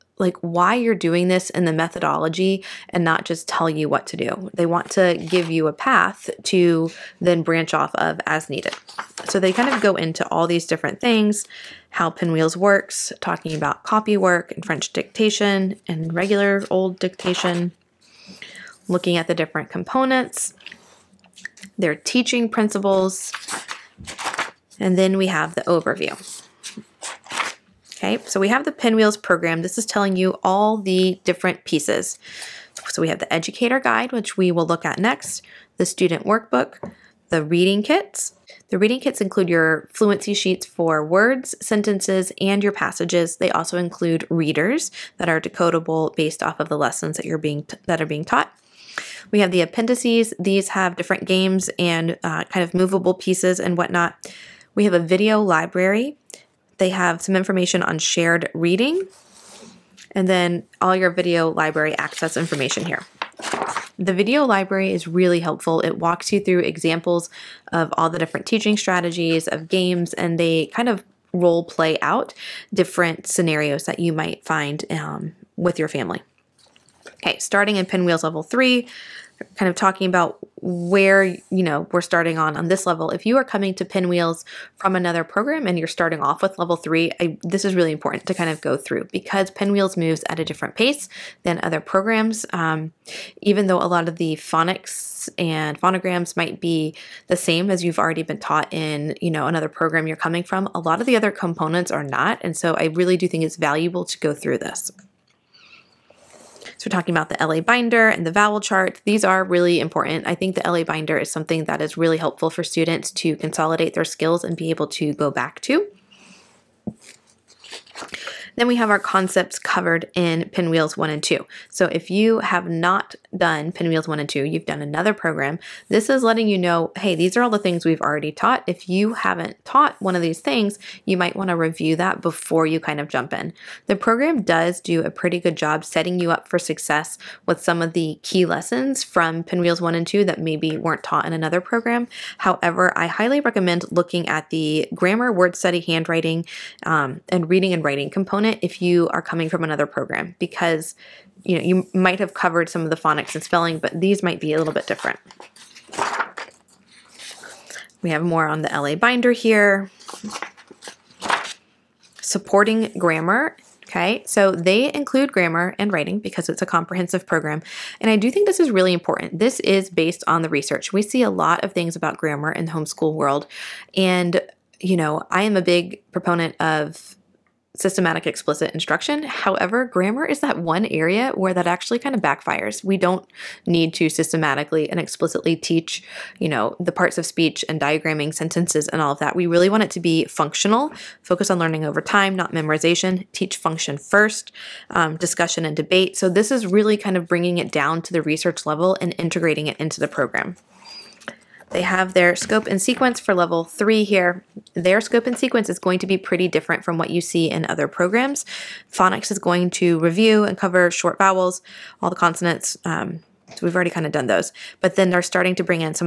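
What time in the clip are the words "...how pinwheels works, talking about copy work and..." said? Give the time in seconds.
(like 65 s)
11 s.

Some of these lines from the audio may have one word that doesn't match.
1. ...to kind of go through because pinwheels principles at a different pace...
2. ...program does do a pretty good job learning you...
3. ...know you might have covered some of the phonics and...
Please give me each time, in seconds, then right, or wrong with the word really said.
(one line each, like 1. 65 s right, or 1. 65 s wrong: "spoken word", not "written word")
1. 88 s wrong: "moves", not "principles"
2. 133 s wrong: "setting", not "learning"
3. 151 s right.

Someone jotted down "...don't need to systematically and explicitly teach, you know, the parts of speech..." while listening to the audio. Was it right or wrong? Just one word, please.
right.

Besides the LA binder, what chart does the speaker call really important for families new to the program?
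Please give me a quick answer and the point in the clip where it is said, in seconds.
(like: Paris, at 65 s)
Vowel chart, at 108 s.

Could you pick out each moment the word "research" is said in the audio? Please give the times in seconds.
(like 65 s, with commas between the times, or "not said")
170 s, 198 s.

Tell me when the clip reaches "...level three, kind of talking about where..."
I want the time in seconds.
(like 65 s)
78 s.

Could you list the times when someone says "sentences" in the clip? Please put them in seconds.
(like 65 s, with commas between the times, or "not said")
41 s, 188 s.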